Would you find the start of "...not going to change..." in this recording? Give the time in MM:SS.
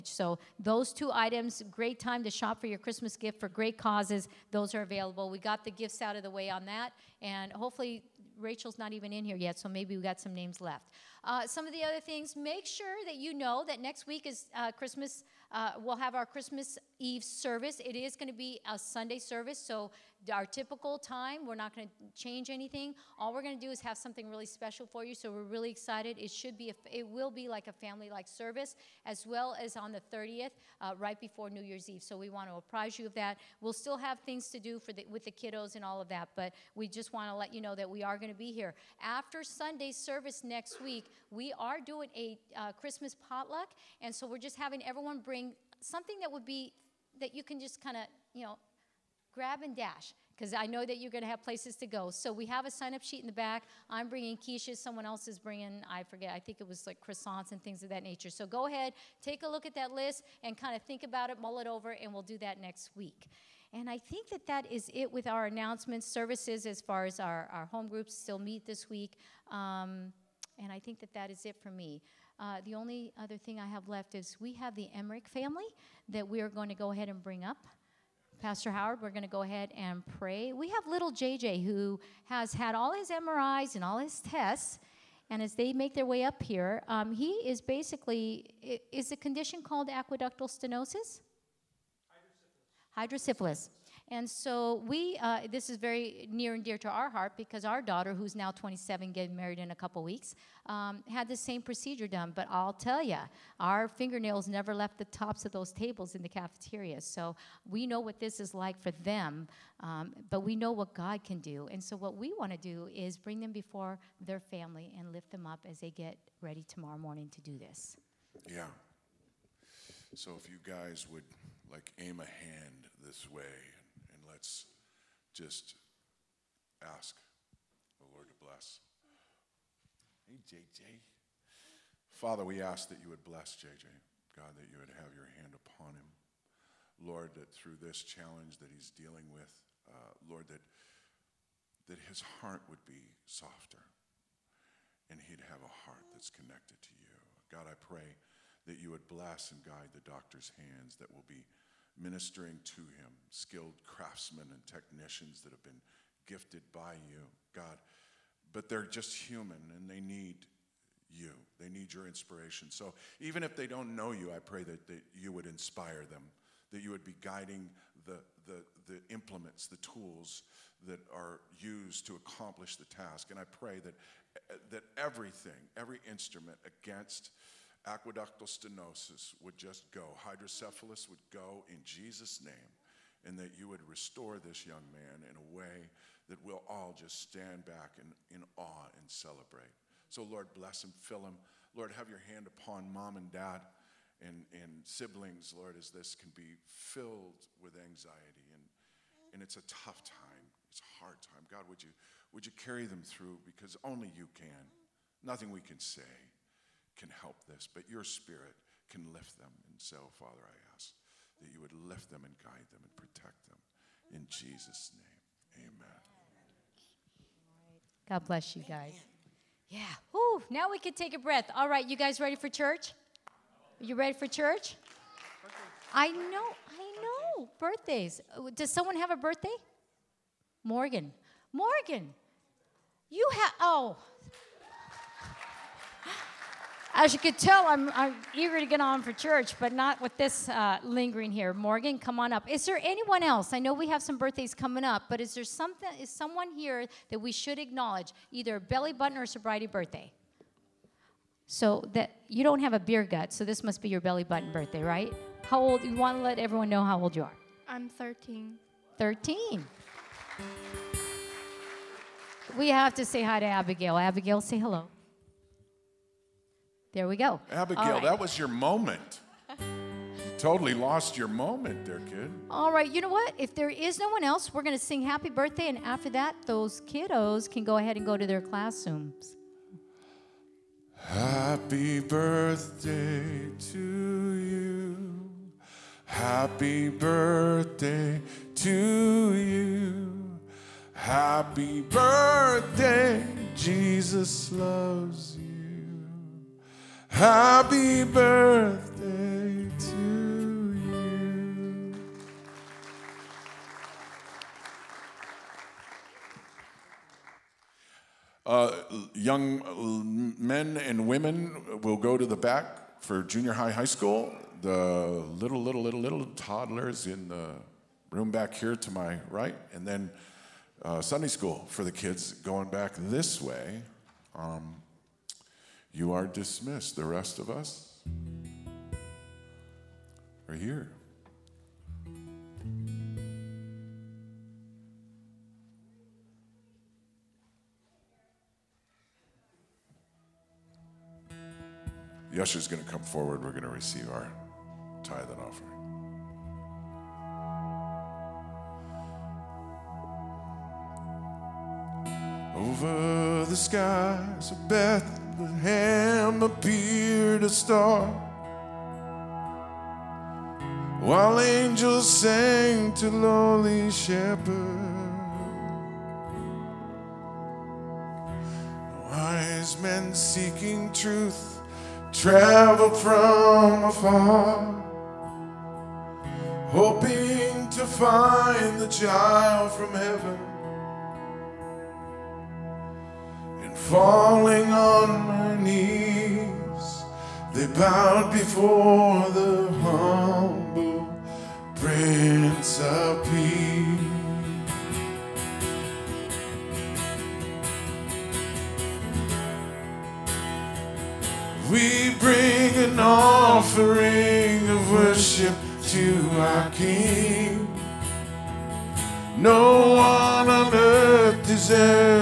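00:21.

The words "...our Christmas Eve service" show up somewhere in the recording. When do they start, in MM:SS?
00:16.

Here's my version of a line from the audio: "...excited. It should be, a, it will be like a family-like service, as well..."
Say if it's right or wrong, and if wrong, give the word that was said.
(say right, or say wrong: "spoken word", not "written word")
right.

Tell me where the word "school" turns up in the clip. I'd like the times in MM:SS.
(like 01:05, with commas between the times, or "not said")
05:13, 05:21.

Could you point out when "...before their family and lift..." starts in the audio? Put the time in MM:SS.
01:53.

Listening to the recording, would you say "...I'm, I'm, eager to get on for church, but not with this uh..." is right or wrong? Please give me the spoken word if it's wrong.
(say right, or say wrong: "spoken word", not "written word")
right.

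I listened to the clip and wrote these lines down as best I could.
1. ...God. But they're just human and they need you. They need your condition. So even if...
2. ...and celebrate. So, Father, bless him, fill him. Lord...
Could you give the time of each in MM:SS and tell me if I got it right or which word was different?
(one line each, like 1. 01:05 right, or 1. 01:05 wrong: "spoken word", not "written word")
1. 02:37 wrong: "inspiration", not "condition"
2. 03:08 wrong: "Lord", not "Father".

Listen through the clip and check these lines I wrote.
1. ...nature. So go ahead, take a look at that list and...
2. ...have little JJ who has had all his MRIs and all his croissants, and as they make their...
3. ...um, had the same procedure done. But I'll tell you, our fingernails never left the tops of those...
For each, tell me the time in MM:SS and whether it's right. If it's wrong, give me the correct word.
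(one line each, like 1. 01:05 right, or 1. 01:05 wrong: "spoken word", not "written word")
1. 00:58 right
2. 01:20 wrong: "tests", not "croissants"
3. 01:40 right.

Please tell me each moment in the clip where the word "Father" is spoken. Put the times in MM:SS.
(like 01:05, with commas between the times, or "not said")
02:12, 03:30.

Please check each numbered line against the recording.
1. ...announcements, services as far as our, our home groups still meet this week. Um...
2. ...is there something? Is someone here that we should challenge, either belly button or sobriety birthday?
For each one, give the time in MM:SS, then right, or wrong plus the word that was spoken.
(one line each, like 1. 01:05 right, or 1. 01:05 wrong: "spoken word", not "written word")
1. 01:05 right
2. 04:05 wrong: "acknowledge", not "challenge".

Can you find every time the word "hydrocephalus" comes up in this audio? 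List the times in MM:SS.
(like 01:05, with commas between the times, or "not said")
01:32, 03:00.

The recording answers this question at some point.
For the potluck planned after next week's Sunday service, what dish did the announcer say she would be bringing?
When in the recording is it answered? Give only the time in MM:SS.
00:54.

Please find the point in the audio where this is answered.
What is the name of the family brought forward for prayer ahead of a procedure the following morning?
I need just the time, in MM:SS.
01:14.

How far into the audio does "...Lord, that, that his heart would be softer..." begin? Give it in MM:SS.
02:20.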